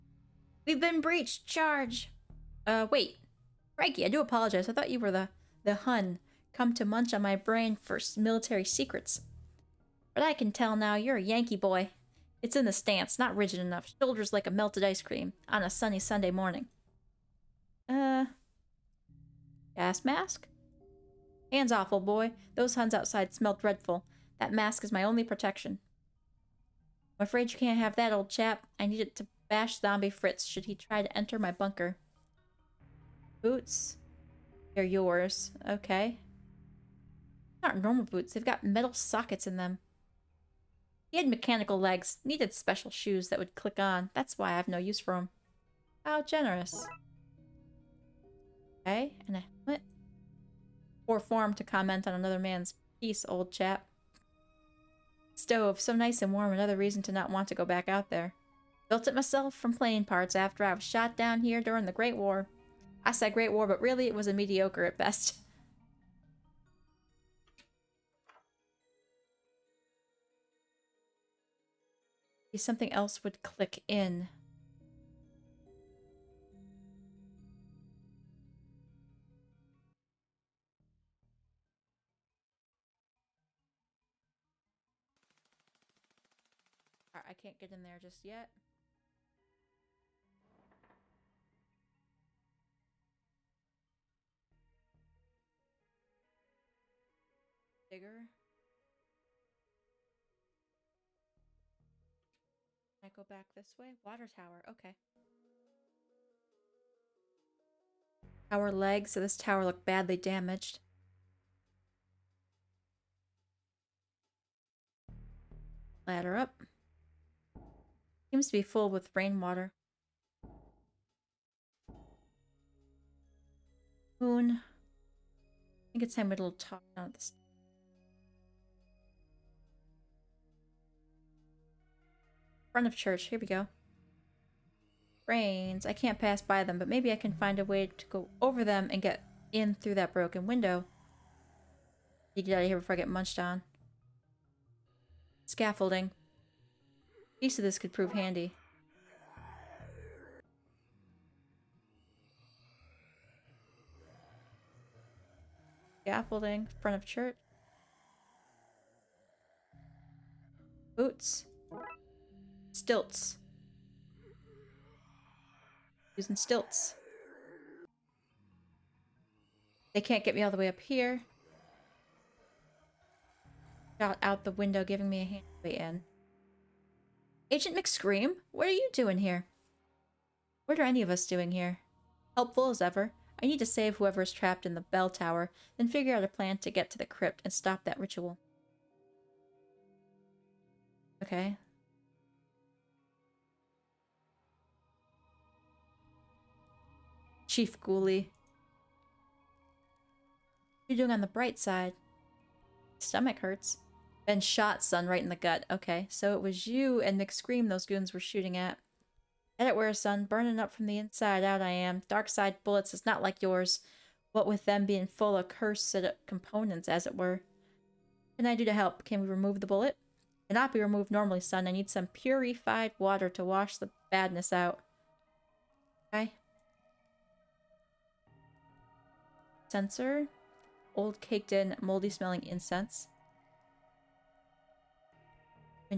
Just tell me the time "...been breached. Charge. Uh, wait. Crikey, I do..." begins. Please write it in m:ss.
0:00.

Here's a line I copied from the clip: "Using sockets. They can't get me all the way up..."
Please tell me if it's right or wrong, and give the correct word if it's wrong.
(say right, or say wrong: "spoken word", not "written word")
wrong: "stilts", not "sockets".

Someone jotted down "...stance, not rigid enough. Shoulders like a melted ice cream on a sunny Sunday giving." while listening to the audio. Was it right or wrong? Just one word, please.
wrong.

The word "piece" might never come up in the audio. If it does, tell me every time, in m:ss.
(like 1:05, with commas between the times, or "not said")
0:52, 2:27.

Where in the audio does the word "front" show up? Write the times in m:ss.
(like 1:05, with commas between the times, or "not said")
2:12, 2:36.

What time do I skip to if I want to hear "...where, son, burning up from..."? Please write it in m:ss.
3:29.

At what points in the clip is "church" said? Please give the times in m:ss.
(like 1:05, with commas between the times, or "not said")
2:12, 2:37.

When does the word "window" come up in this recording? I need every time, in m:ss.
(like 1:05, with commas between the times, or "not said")
2:20, 2:54.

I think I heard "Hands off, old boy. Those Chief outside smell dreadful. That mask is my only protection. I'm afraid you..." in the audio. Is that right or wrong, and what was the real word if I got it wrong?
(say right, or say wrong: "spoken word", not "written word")
wrong: "Huns", not "Chief".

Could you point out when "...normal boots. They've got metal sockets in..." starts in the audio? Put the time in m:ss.
0:37.